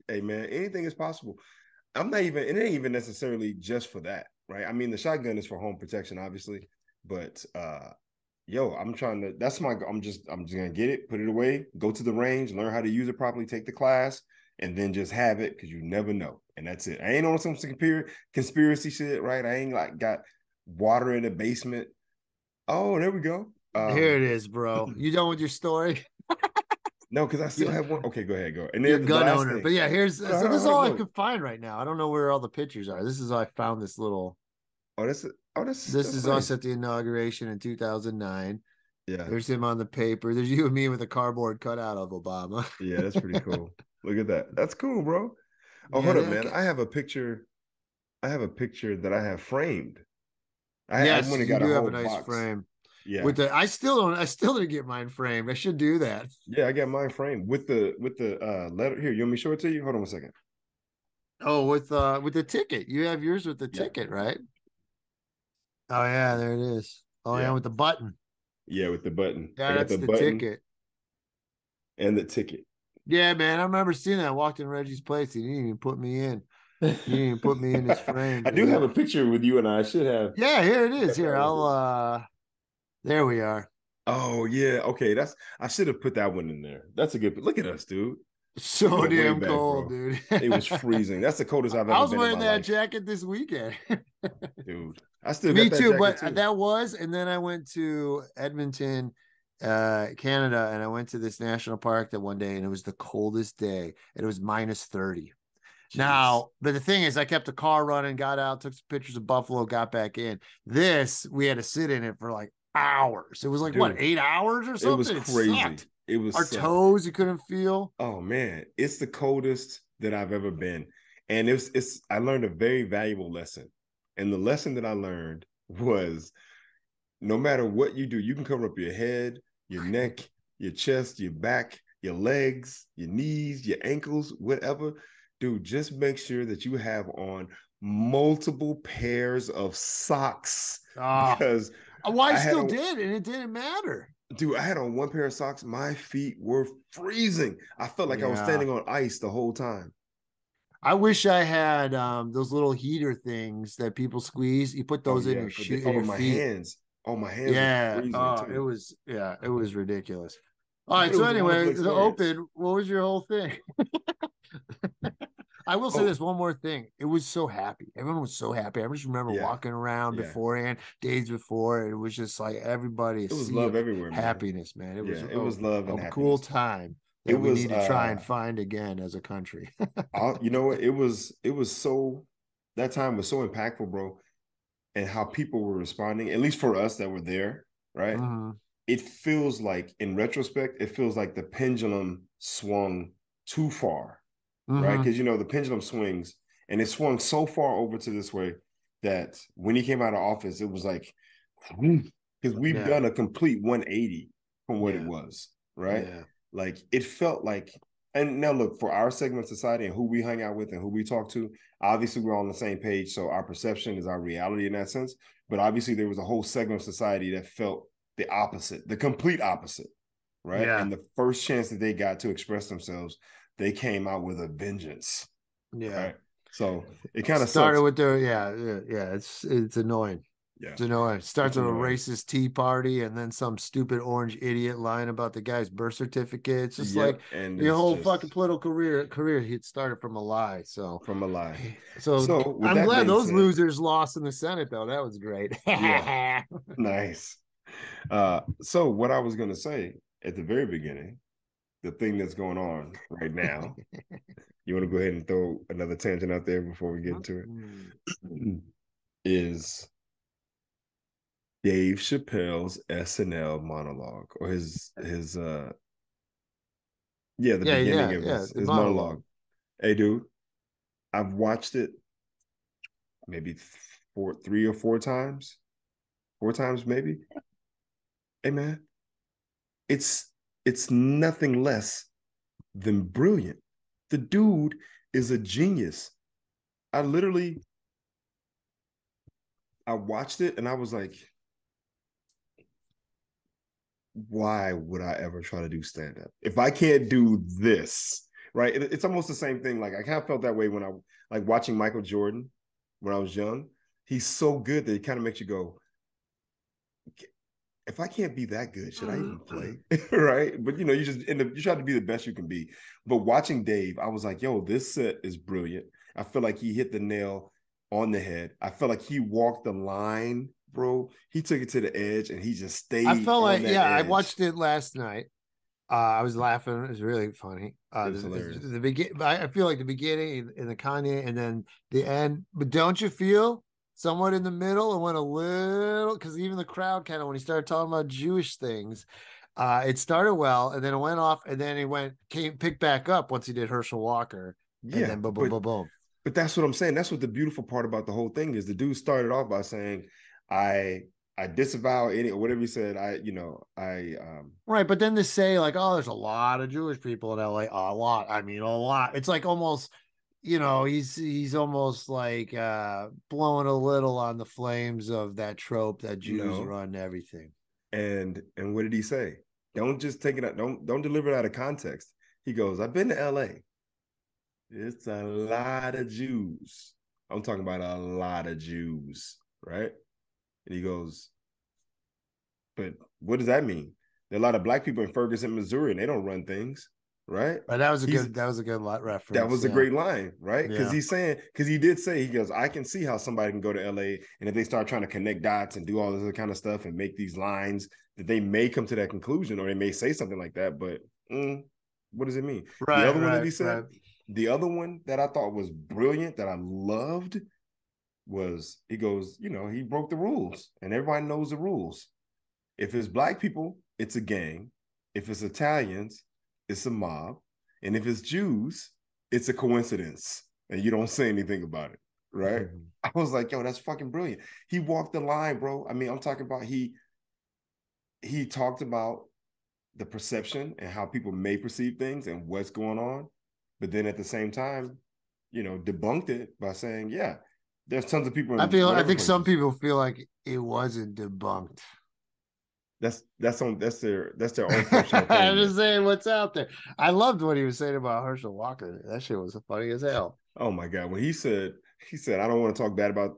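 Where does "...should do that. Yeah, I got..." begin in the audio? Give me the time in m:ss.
0:55.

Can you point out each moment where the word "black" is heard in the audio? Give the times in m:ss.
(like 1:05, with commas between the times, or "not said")
6:24, 6:53.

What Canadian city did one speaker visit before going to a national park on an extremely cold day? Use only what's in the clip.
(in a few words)
Edmonton.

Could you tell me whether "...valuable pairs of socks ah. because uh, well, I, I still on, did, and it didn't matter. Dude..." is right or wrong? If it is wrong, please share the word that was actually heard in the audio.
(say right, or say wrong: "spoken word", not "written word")
wrong: "multiple", not "valuable".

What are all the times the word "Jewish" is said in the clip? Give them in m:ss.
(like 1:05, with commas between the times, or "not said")
5:38, 5:56.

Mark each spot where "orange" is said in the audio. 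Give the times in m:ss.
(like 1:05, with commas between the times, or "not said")
3:54.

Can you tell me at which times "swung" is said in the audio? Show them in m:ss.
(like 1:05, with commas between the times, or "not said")
3:12, 3:16.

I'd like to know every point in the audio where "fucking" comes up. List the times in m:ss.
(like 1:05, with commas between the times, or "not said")
3:58, 7:03.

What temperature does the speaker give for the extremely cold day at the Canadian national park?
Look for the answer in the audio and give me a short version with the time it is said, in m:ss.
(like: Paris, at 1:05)
-30, at 1:44.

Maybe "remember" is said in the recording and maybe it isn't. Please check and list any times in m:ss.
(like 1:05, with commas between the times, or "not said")
1:13, 2:49.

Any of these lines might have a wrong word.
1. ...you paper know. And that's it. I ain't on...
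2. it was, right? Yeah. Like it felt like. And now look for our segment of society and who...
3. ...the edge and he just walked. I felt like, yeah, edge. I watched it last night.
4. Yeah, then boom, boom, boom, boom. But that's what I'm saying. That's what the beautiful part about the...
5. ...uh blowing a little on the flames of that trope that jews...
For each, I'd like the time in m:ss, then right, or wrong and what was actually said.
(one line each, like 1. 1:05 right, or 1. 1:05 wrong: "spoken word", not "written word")
1. 0:15 wrong: "never", not "paper"
2. 3:25 right
3. 5:21 wrong: "stayed", not "walked"
4. 5:44 right
5. 6:02 right.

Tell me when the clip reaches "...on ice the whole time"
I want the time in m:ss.
2:28.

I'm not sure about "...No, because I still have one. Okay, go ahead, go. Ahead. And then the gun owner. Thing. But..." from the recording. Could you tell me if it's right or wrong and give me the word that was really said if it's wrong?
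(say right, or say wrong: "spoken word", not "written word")
right.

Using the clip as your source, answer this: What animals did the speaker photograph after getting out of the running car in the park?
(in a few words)
Buffalo.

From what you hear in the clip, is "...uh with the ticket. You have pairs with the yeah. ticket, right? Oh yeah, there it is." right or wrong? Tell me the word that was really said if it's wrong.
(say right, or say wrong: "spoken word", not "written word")
wrong: "yours", not "pairs".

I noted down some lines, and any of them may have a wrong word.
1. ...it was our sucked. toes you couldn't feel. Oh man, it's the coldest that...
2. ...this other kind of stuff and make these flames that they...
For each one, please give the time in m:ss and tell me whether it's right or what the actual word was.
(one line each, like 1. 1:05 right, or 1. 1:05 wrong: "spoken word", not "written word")
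1. 1:56 right
2. 6:36 wrong: "lines", not "flames".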